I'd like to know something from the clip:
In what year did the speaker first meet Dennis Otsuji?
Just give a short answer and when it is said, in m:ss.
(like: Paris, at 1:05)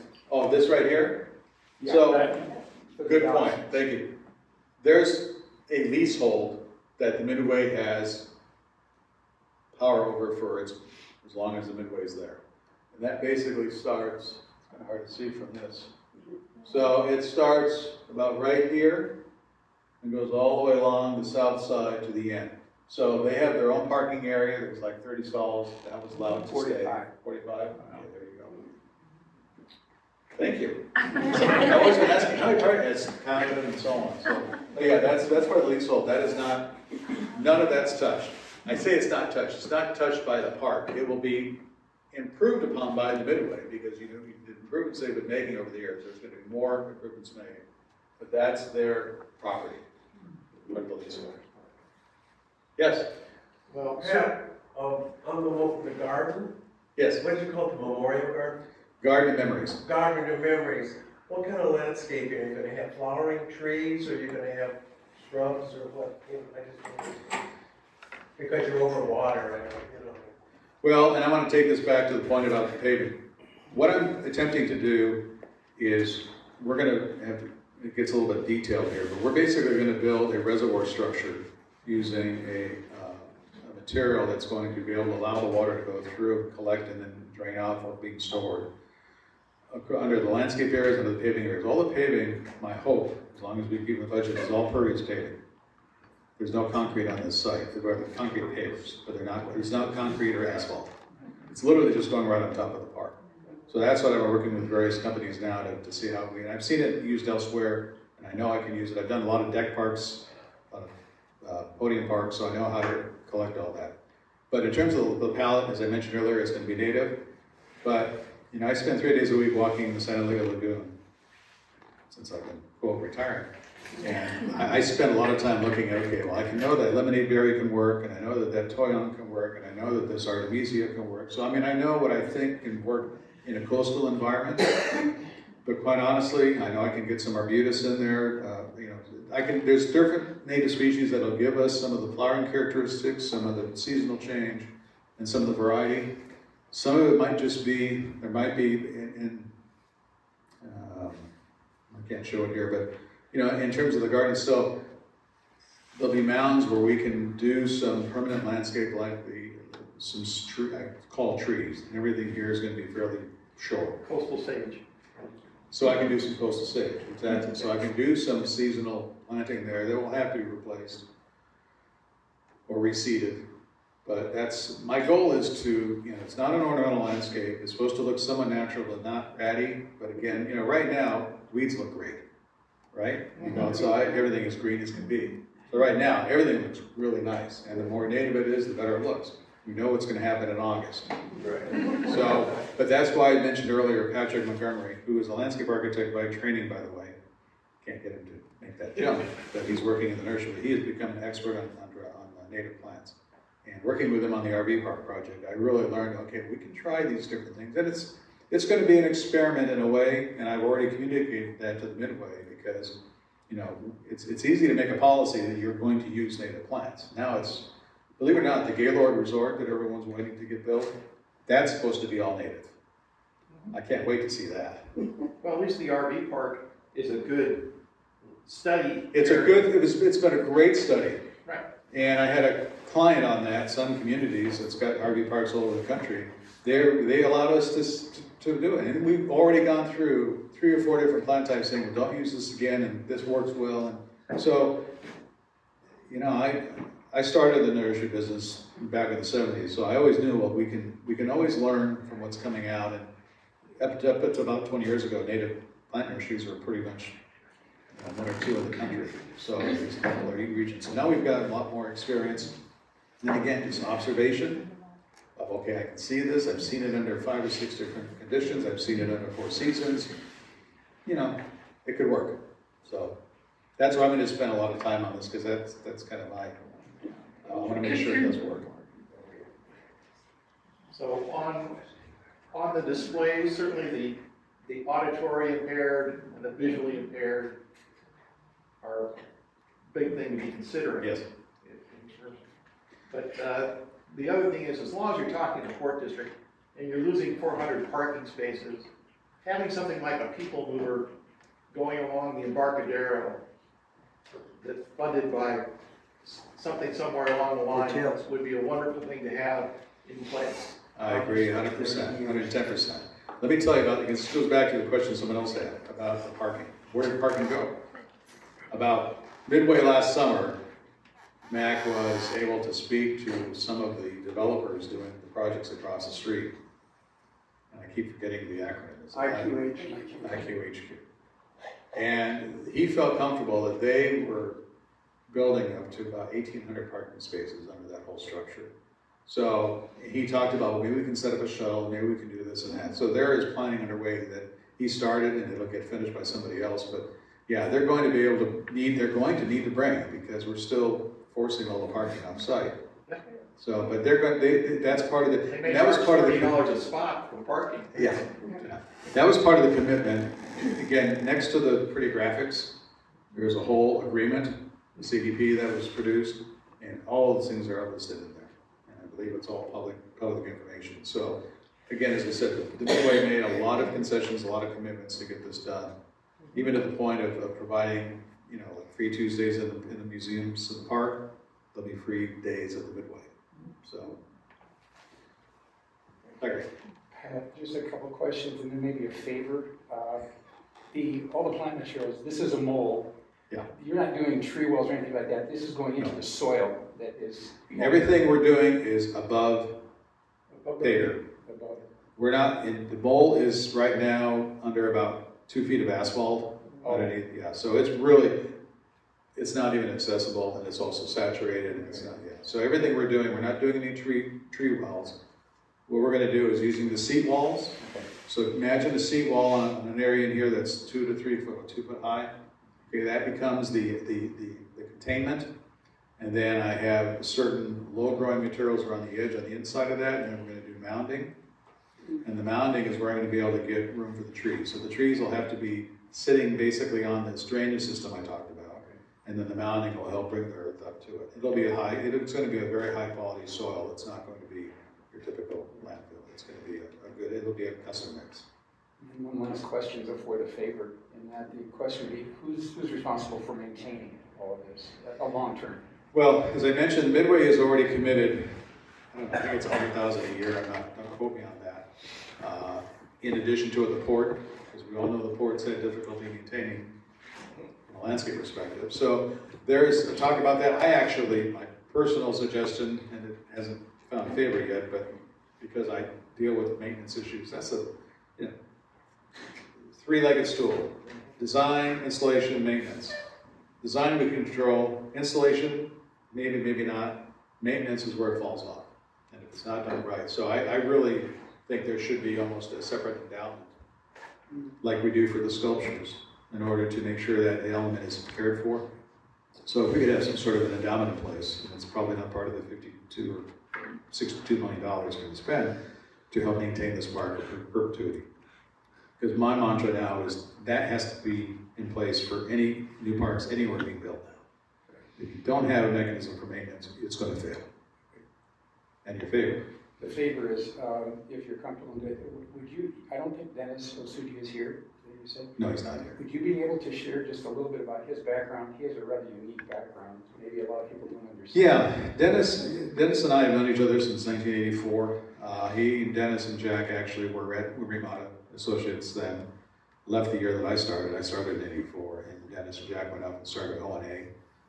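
1984, at 8:54.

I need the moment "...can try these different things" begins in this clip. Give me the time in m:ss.
3:26.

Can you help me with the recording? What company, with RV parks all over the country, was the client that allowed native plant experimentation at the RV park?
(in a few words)
Sun Communities.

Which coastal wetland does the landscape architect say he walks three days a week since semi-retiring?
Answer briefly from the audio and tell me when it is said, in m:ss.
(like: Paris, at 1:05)
San Dieguito Lagoon, at 2:00.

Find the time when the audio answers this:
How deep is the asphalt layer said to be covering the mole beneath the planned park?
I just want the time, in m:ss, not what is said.
6:45.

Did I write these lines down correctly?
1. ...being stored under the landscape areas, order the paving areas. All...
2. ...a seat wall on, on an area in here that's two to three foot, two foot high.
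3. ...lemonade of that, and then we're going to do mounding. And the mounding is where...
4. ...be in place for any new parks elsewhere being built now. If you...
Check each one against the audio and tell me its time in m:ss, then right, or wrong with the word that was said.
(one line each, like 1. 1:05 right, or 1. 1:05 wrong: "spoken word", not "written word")
1. 1:28 wrong: "under", not "order"
2. 6:58 right
3. 7:09 wrong: "inside", not "lemonade"
4. 8:31 wrong: "anywhere", not "elsewhere".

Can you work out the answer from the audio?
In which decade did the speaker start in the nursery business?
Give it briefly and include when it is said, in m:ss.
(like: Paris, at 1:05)
the 70s, at 4:09.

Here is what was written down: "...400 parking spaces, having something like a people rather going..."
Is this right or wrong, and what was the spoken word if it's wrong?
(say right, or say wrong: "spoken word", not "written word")
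wrong: "mover", not "rather".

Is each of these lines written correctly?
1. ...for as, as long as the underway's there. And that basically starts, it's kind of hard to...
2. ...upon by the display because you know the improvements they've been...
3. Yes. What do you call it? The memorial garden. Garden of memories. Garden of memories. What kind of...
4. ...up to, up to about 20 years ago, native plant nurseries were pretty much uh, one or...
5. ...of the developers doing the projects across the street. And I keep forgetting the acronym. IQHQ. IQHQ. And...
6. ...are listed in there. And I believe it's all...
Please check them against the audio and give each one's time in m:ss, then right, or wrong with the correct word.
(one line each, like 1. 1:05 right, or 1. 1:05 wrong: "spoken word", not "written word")
1. 0:10 wrong: "midway", not "underway"
2. 0:42 wrong: "midway", not "display"
3. 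0:56 right
4. 4:13 right
5. 5:23 right
6. 6:07 right.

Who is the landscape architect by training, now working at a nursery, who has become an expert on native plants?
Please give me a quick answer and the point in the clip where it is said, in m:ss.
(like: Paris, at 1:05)
Patrick Montgomery, at 3:14.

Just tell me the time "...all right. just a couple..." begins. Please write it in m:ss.
6:26.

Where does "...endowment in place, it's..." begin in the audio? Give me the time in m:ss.
8:20.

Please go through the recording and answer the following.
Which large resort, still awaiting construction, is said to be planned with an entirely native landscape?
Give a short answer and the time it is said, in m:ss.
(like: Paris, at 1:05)
Gaylord Resort, at 3:38.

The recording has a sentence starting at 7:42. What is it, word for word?
Uh, in addition to it, the port we all know the ports had difficulty maintaining from a landscape perspective.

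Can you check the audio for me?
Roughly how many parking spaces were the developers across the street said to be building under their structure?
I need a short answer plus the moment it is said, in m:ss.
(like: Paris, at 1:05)
1,800, at 5:36.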